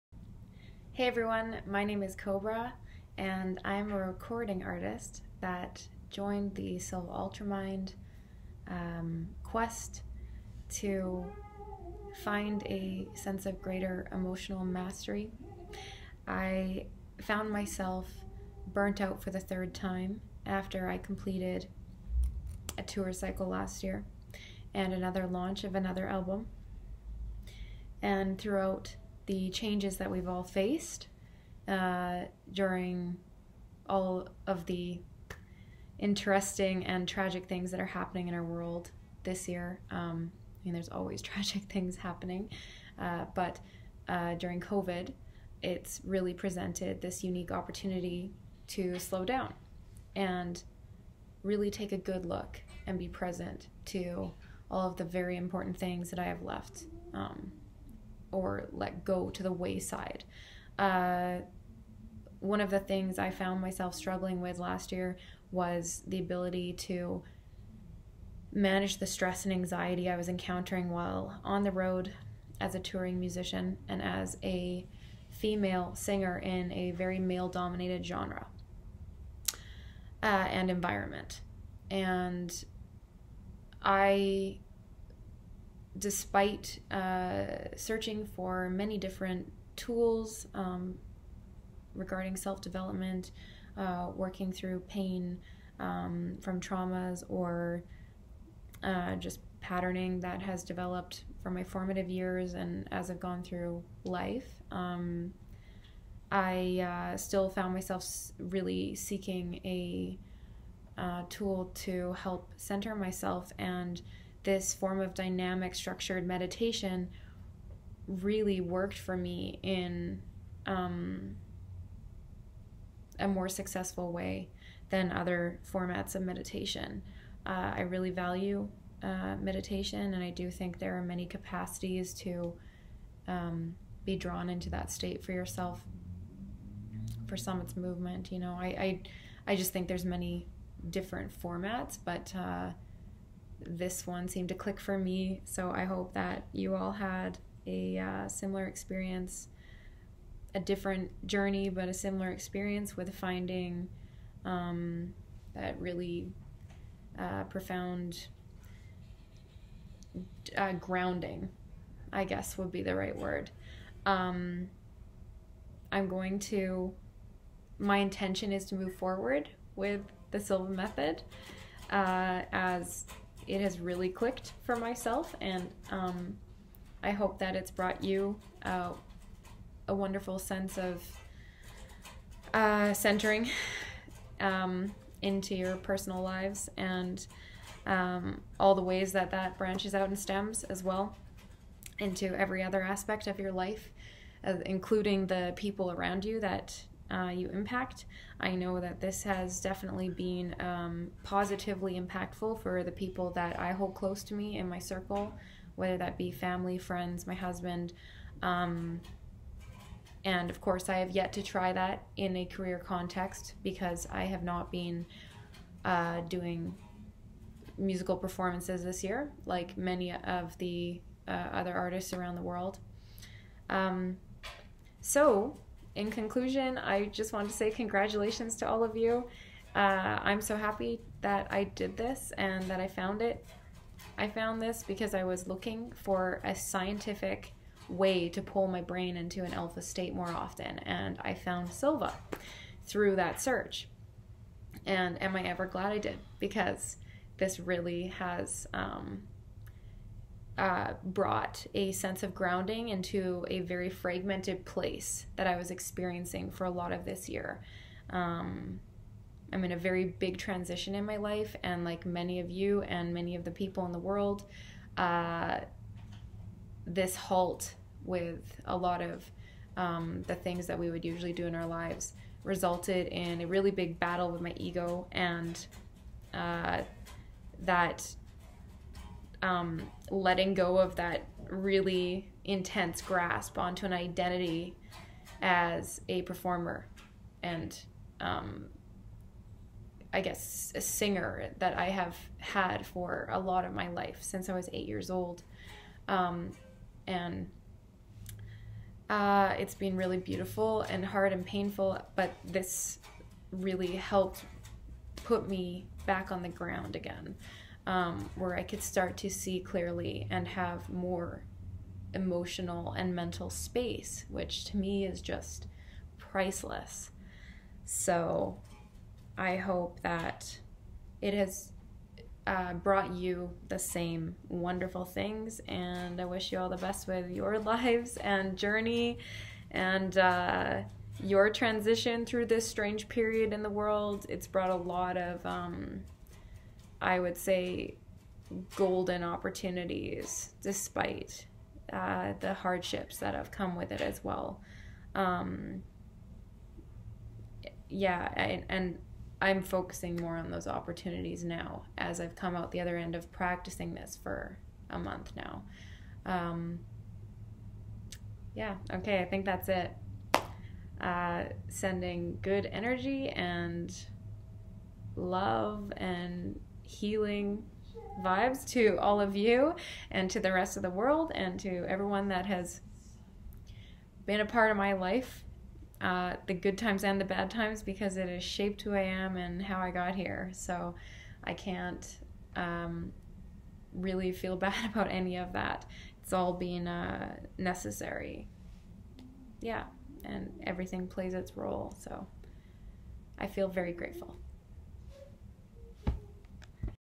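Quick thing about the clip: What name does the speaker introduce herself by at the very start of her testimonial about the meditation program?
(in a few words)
Kobra.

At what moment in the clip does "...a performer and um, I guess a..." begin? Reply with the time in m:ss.
4:46.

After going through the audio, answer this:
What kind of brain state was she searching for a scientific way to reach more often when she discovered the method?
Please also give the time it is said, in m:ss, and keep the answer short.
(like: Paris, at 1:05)
Alpha state, at 3:59.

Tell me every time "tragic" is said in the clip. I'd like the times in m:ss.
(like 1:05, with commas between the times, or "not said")
0:37, 0:41.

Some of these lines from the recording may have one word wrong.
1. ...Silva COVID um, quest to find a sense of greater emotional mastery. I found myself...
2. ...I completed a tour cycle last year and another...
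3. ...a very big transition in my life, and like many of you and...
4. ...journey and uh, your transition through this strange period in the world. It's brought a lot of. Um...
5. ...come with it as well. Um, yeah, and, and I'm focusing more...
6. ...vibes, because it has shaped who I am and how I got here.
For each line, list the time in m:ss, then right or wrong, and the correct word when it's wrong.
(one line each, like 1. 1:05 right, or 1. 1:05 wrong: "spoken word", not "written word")
1. 0:06 wrong: "Ultramind", not "COVID"
2. 0:20 right
3. 4:19 right
4. 5:28 right
5. 5:43 right
6. 6:17 wrong: "times", not "vibes".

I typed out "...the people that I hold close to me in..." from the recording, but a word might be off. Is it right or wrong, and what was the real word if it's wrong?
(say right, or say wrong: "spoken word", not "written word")
right.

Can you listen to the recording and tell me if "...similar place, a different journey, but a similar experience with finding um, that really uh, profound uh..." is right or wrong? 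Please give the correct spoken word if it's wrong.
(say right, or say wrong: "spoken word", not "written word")
wrong: "experience", not "place".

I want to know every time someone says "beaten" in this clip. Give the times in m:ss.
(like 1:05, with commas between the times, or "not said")
not said.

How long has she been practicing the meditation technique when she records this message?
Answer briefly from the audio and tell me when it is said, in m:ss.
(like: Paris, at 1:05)
A month, at 5:54.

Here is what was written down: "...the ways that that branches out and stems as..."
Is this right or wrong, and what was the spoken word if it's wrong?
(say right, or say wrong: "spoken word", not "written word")
right.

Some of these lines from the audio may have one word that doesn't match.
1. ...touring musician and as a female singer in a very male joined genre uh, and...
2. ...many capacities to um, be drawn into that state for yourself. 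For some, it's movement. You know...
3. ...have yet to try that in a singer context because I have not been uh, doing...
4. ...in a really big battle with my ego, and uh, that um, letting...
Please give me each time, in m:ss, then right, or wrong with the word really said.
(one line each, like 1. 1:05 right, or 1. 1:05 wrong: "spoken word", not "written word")
1. 1:12 wrong: "dominated", not "joined"
2. 2:11 right
3. 3:30 wrong: "career", not "singer"
4. 4:33 right.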